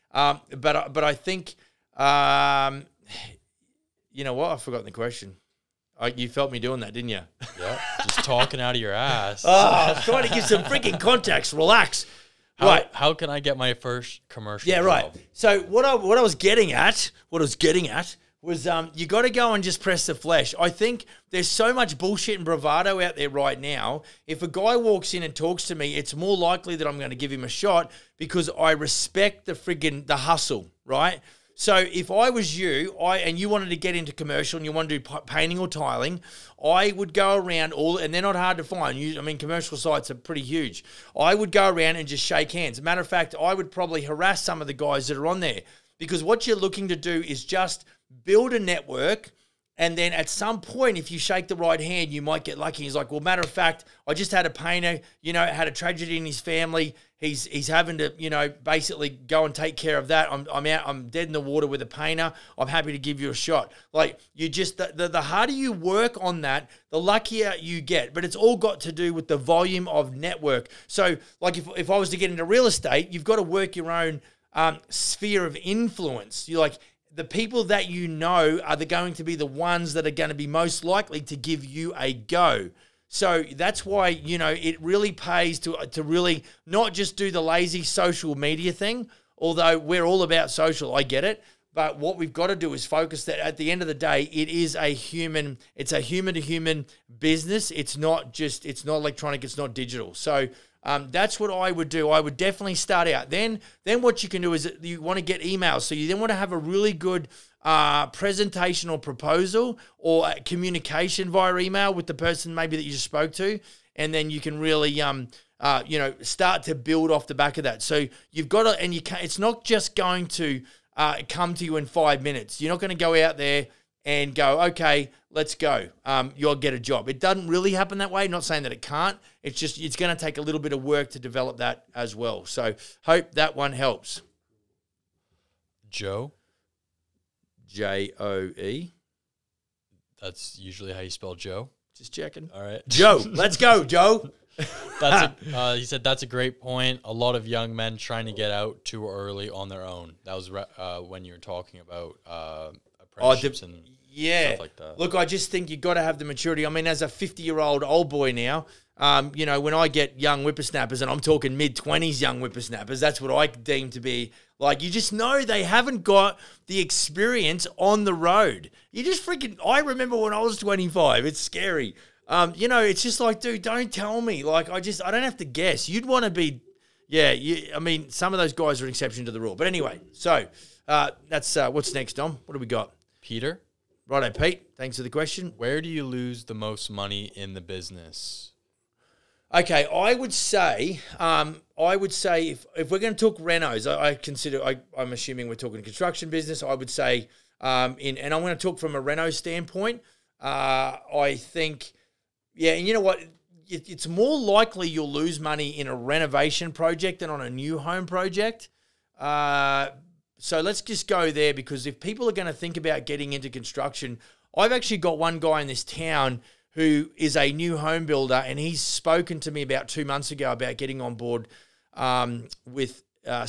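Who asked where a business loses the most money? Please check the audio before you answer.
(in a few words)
Peter.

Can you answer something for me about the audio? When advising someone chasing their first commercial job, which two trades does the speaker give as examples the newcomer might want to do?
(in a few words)
painting or tiling.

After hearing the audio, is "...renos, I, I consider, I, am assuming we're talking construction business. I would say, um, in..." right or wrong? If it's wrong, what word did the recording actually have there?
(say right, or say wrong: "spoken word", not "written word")
right.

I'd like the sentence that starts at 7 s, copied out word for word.
Yeah, just talking out of your ass.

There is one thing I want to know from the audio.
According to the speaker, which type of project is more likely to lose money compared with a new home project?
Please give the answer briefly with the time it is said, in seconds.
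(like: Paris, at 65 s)
A renovation project, at 205 s.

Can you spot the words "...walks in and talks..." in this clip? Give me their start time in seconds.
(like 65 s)
24 s.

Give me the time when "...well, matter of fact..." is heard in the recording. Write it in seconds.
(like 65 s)
53 s.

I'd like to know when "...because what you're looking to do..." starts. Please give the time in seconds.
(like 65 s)
45 s.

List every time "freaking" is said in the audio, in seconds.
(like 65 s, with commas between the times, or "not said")
10 s, 169 s.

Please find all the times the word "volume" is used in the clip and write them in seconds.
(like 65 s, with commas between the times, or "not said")
69 s.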